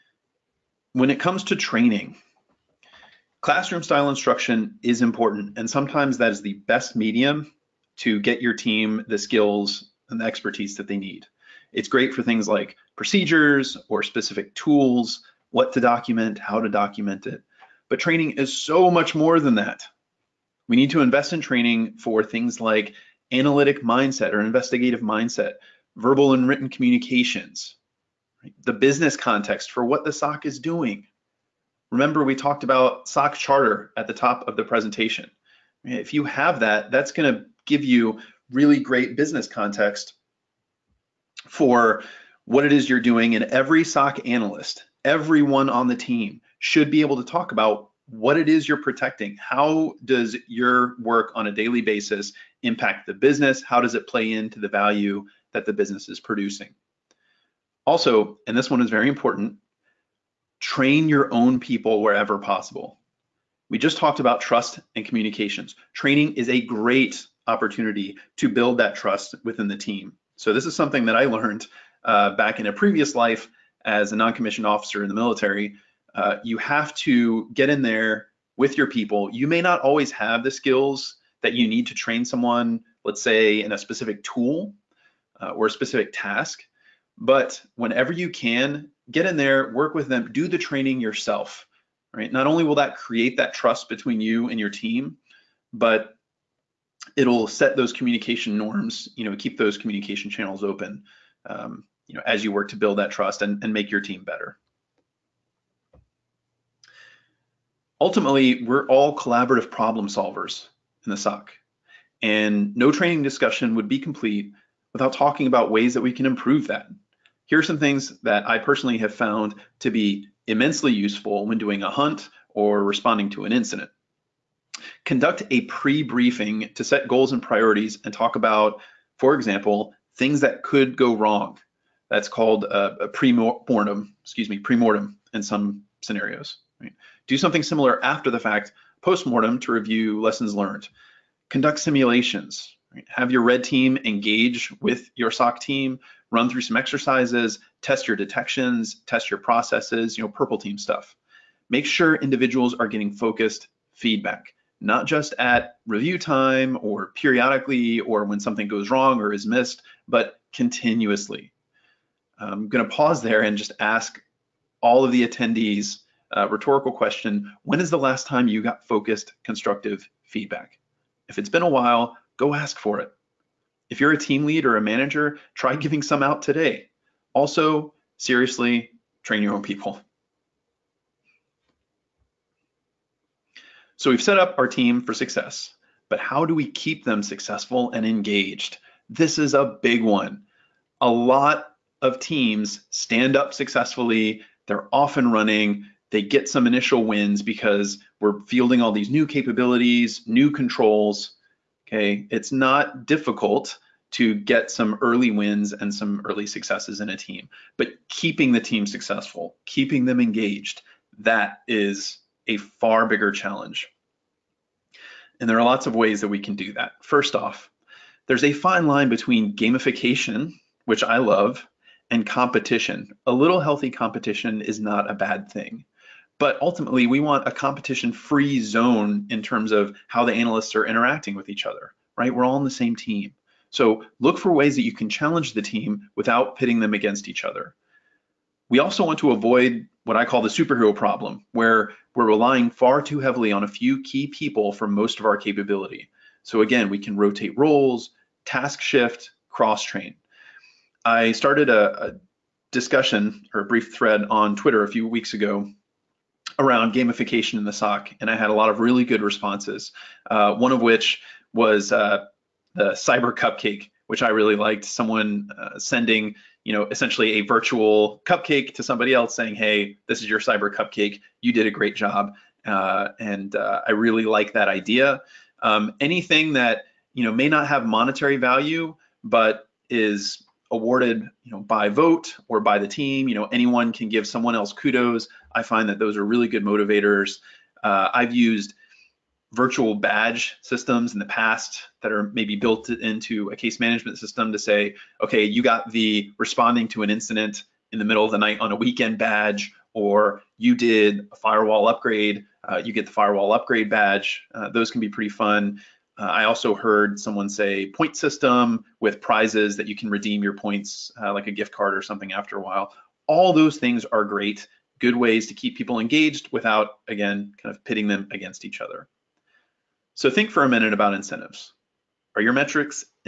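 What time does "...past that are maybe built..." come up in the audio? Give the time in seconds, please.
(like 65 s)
291 s.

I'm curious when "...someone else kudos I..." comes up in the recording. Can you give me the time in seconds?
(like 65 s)
284 s.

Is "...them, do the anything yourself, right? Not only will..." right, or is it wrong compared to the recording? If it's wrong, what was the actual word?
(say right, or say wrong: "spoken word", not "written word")
wrong: "training", not "anything".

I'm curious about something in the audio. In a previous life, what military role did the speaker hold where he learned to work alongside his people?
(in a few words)
non-commissioned officer.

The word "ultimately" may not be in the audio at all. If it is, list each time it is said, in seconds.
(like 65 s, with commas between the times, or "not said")
108 s, 226 s.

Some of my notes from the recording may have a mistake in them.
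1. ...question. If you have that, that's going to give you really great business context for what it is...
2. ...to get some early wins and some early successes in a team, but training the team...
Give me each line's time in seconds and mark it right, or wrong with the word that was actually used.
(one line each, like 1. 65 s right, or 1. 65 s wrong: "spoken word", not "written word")
1. 34 s wrong: "presentation", not "question"
2. 204 s wrong: "keeping", not "training".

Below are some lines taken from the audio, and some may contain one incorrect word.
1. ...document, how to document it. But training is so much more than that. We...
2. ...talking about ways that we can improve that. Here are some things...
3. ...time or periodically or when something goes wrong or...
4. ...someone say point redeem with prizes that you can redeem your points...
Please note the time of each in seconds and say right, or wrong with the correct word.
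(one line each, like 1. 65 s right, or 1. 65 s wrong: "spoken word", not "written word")
1. 15 s right
2. 115 s right
3. 156 s right
4. 307 s wrong: "system", not "redeem".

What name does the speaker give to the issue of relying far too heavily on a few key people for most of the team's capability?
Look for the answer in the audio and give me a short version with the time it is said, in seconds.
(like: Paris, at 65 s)
superhero problem, at 240 s.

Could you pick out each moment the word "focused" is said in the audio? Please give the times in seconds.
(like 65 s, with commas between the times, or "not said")
153 s, 168 s.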